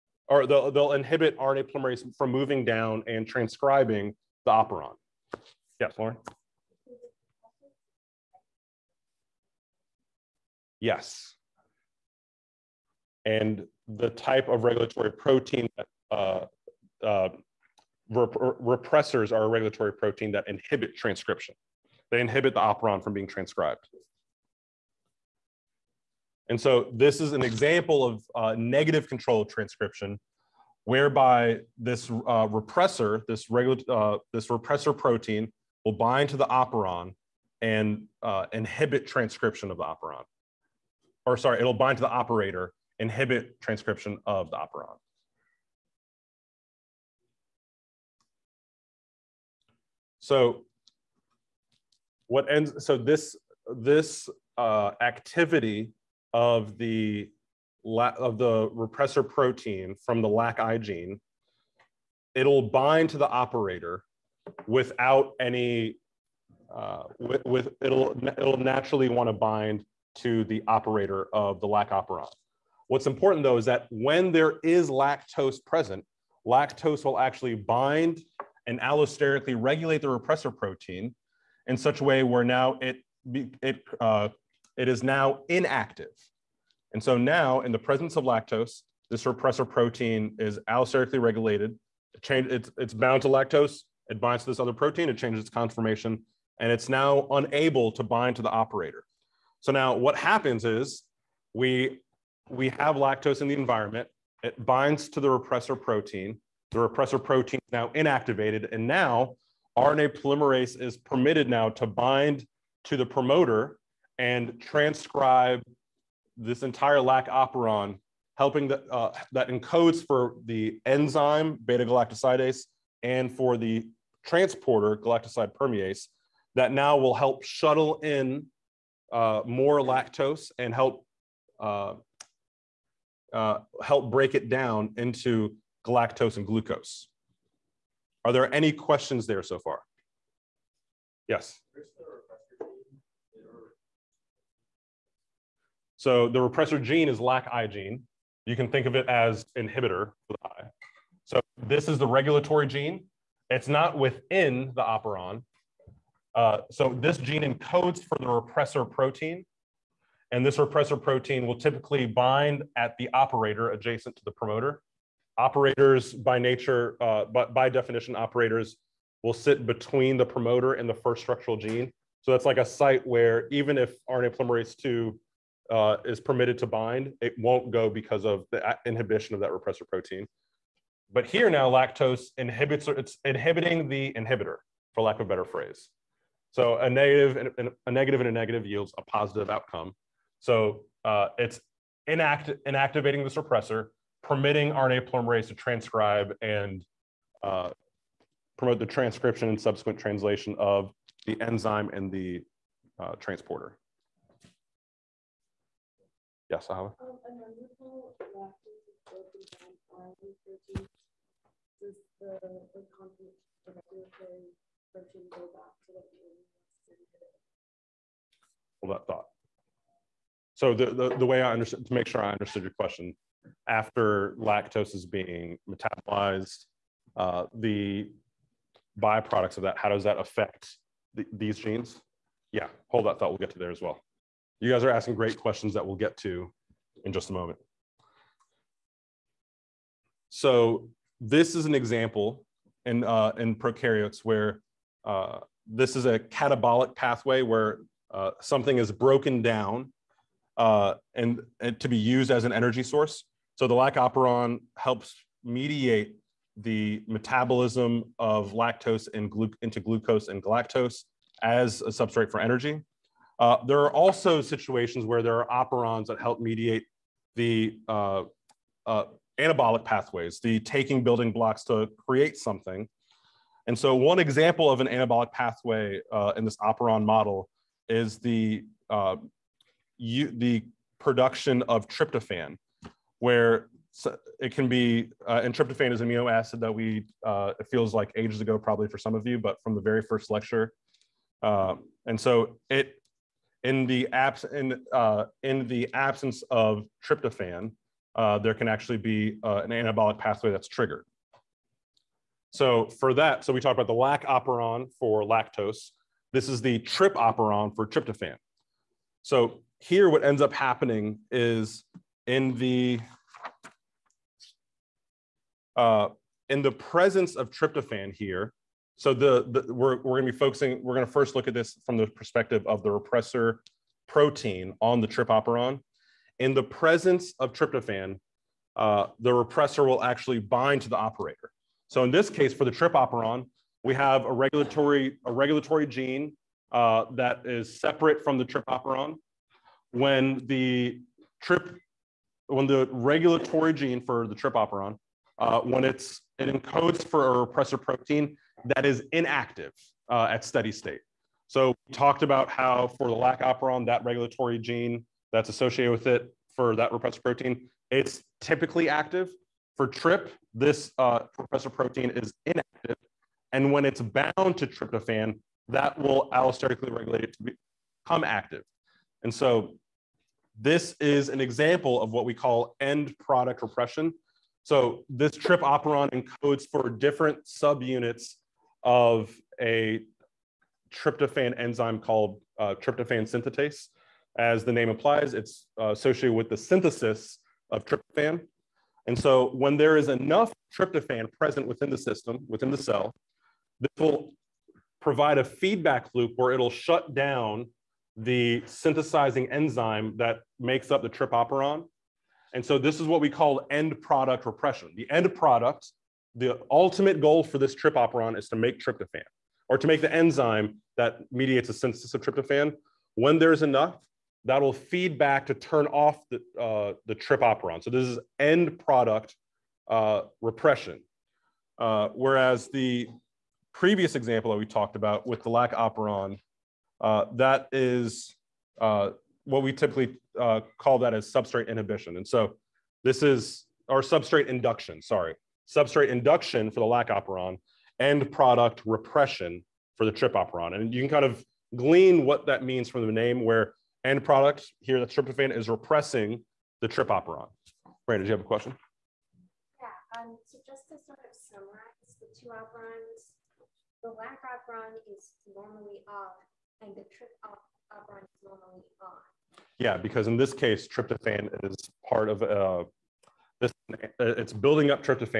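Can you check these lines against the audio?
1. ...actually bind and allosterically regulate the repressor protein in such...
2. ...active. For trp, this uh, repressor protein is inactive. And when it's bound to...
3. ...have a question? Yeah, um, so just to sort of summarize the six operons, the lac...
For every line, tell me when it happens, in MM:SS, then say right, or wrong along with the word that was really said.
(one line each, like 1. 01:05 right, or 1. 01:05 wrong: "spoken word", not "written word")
1. 01:17 right
2. 05:58 right
3. 07:28 wrong: "two", not "six".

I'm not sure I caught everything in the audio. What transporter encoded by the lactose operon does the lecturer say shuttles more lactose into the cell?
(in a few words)
galactoside permease.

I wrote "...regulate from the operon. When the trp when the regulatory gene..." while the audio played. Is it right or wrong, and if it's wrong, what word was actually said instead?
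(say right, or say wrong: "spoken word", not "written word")
wrong: "separate", not "regulate".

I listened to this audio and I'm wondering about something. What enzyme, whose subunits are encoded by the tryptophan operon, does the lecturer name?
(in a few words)
tryptophan synthetase.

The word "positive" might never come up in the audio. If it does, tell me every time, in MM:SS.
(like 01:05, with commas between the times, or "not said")
03:09.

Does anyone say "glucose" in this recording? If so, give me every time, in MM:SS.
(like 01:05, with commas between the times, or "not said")
02:16, 04:19.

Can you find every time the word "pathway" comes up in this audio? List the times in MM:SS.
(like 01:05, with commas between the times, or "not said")
04:06, 04:29, 04:35, 05:00.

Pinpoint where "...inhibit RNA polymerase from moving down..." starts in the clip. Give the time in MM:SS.
00:00.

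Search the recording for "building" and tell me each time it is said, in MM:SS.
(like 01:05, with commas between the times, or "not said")
04:31, 07:44.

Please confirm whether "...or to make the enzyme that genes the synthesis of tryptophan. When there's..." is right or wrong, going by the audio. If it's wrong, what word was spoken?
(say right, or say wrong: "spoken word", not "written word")
wrong: "mediates", not "genes".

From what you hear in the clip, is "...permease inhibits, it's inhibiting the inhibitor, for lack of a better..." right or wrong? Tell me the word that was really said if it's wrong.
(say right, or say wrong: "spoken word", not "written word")
wrong: "lactose", not "permease".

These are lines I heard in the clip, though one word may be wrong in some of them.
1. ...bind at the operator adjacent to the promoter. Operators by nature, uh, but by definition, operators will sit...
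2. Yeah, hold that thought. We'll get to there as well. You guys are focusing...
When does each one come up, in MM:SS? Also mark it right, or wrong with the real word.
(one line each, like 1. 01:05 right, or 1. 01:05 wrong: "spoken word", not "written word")
1. 02:42 right
2. 03:52 wrong: "asking", not "focusing".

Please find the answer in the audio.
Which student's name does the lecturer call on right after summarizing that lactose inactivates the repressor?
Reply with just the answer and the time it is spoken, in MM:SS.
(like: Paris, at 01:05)
Ahava, at 03:26.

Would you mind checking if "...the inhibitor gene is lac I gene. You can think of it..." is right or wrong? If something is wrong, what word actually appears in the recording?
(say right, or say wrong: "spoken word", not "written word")
wrong: "repressor", not "inhibitor".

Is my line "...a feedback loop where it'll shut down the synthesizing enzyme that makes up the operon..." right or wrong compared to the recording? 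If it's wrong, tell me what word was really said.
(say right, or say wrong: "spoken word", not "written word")
right.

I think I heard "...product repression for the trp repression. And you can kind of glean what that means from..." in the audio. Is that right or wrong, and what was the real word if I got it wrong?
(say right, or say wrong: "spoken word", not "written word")
wrong: "operon", not "repression".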